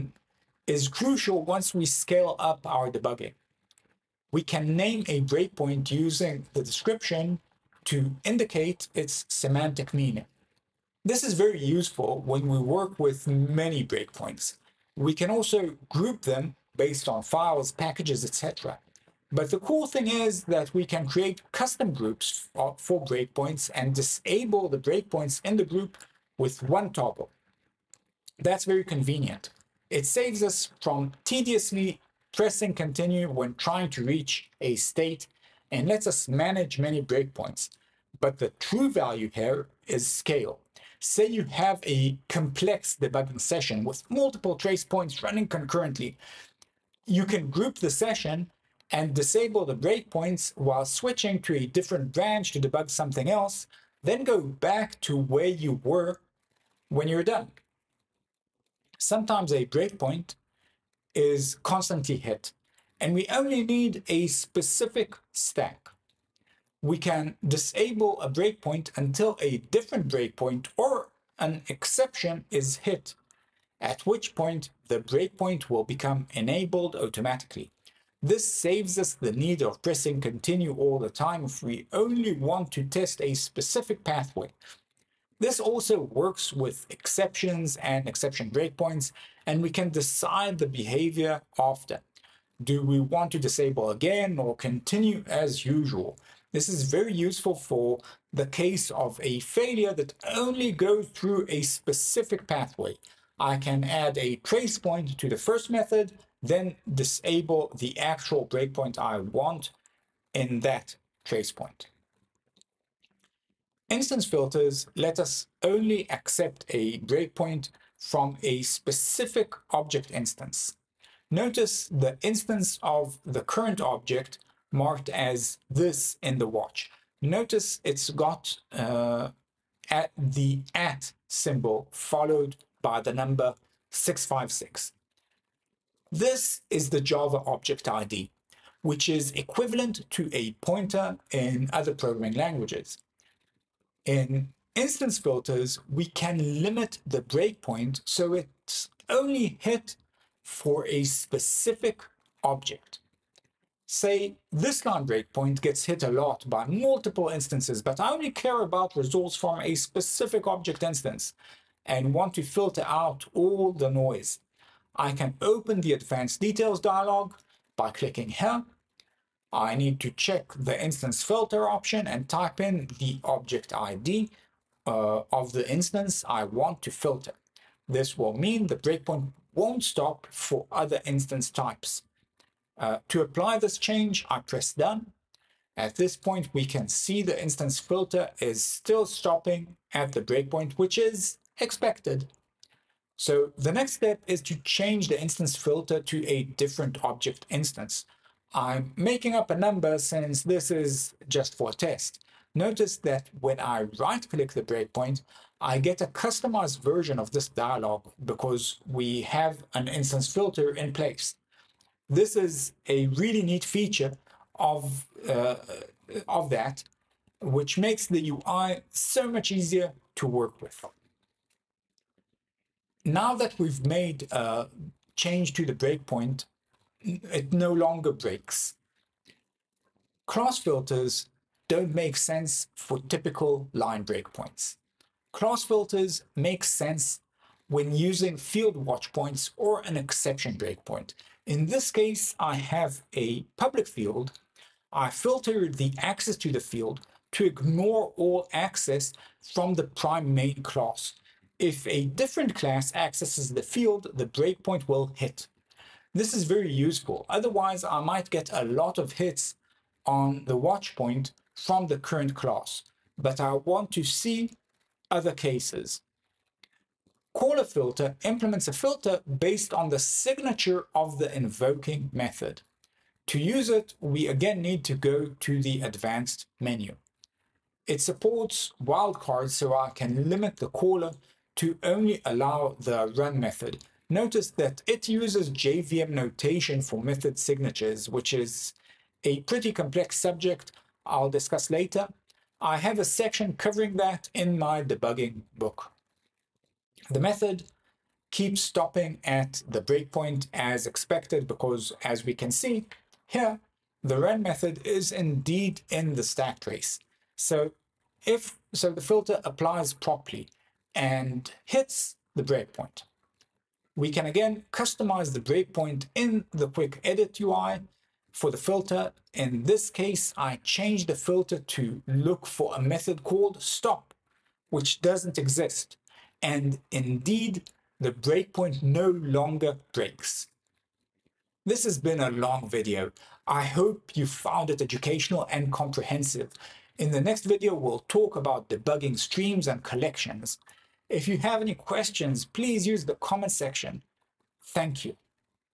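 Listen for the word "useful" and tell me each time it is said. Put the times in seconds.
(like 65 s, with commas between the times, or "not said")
11 s, 97 s, 256 s.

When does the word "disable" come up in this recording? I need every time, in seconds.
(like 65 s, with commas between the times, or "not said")
23 s, 49 s, 67 s, 93 s, 106 s.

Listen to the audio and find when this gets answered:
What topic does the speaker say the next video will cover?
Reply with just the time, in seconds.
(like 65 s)
338 s.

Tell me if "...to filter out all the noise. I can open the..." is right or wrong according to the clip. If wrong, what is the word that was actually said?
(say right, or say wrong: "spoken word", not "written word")
right.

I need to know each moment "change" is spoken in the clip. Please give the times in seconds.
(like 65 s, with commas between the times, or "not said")
183 s, 194 s, 225 s, 320 s.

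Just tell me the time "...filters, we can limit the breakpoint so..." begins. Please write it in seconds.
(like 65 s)
145 s.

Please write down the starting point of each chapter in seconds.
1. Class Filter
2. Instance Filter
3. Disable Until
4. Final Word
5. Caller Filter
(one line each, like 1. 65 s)
1. 228 s
2. 111 s
3. 57 s
4. 329 s
5. 265 s.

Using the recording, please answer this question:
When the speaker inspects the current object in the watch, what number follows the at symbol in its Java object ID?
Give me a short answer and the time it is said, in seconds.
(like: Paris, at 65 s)
656, at 133 s.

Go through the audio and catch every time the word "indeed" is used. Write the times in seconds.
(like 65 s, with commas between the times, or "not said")
305 s, 326 s.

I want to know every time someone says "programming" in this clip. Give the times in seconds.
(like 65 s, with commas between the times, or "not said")
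141 s.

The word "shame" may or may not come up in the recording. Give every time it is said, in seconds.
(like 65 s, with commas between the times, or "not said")
not said.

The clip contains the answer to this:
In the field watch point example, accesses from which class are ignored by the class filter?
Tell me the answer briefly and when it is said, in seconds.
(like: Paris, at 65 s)
prime main class, at 249 s.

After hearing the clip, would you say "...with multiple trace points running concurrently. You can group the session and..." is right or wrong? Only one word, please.
right.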